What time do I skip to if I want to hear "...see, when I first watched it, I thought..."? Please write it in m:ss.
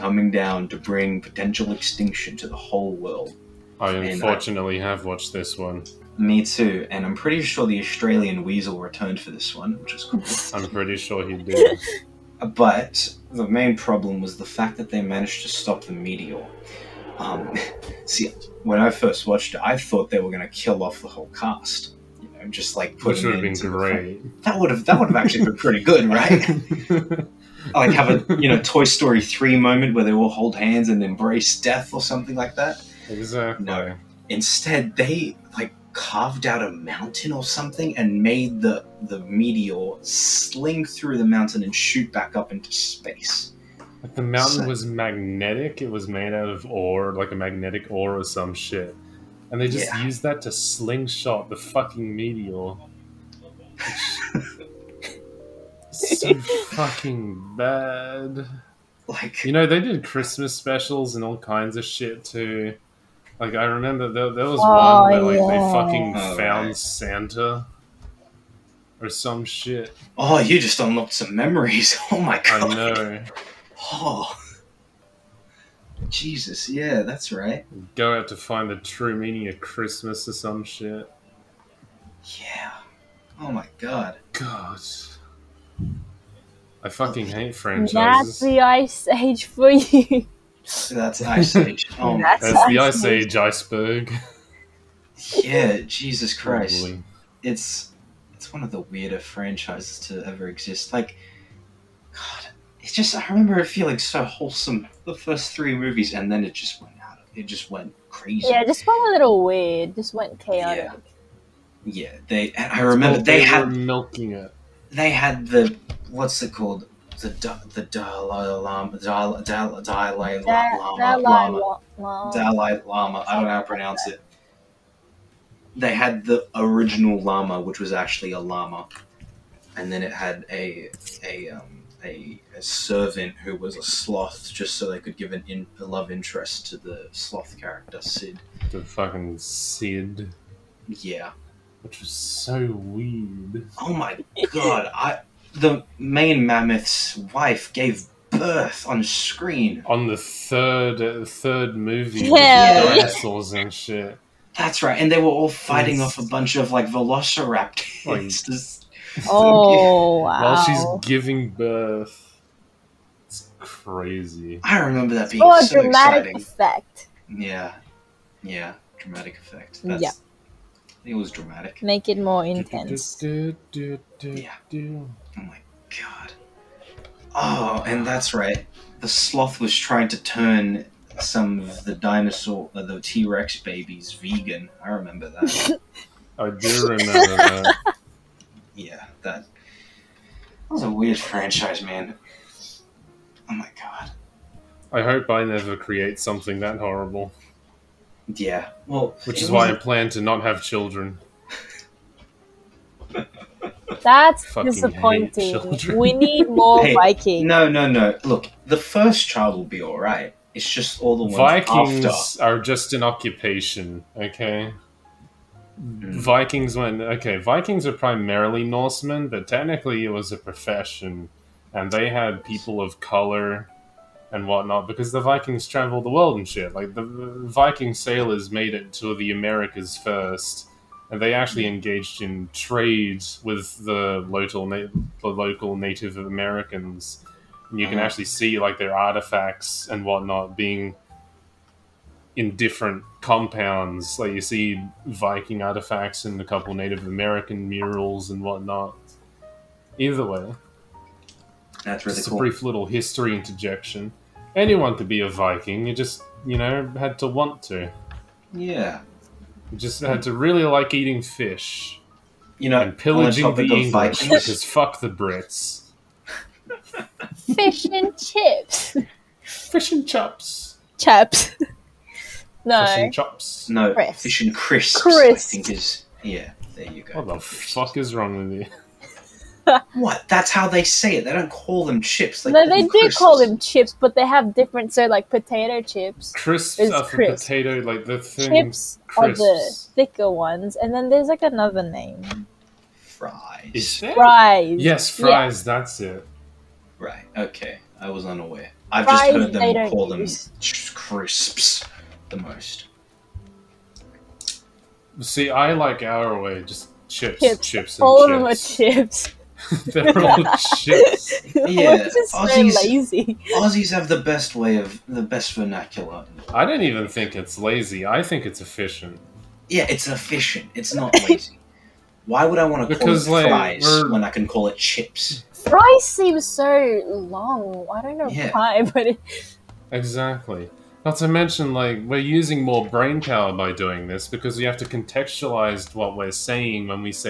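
0:18.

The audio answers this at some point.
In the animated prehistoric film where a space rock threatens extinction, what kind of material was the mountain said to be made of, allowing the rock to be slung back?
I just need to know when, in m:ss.
0:47.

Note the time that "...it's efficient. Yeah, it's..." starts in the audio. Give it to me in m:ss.
5:18.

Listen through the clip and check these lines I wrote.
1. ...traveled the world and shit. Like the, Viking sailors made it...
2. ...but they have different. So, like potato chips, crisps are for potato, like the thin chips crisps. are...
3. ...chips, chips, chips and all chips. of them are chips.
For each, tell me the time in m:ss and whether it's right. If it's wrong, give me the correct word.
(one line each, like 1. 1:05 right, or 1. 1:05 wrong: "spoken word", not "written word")
1. 3:45 right
2. 4:43 right
3. 5:07 right.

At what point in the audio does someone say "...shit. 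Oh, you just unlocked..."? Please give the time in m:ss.
1:09.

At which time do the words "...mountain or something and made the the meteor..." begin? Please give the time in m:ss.
0:36.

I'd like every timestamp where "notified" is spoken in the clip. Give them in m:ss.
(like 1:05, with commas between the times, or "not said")
not said.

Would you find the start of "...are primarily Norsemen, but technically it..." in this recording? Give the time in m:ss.
3:37.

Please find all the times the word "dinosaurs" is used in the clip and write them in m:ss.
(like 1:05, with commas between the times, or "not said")
2:32, 3:01.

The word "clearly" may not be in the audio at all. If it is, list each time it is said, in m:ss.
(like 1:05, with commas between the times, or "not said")
not said.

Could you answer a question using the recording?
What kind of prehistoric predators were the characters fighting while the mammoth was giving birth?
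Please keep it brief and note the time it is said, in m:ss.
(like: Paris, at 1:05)
velociraptors, at 2:36.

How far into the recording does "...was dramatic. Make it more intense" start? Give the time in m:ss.
2:51.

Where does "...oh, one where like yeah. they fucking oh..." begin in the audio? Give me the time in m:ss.
1:04.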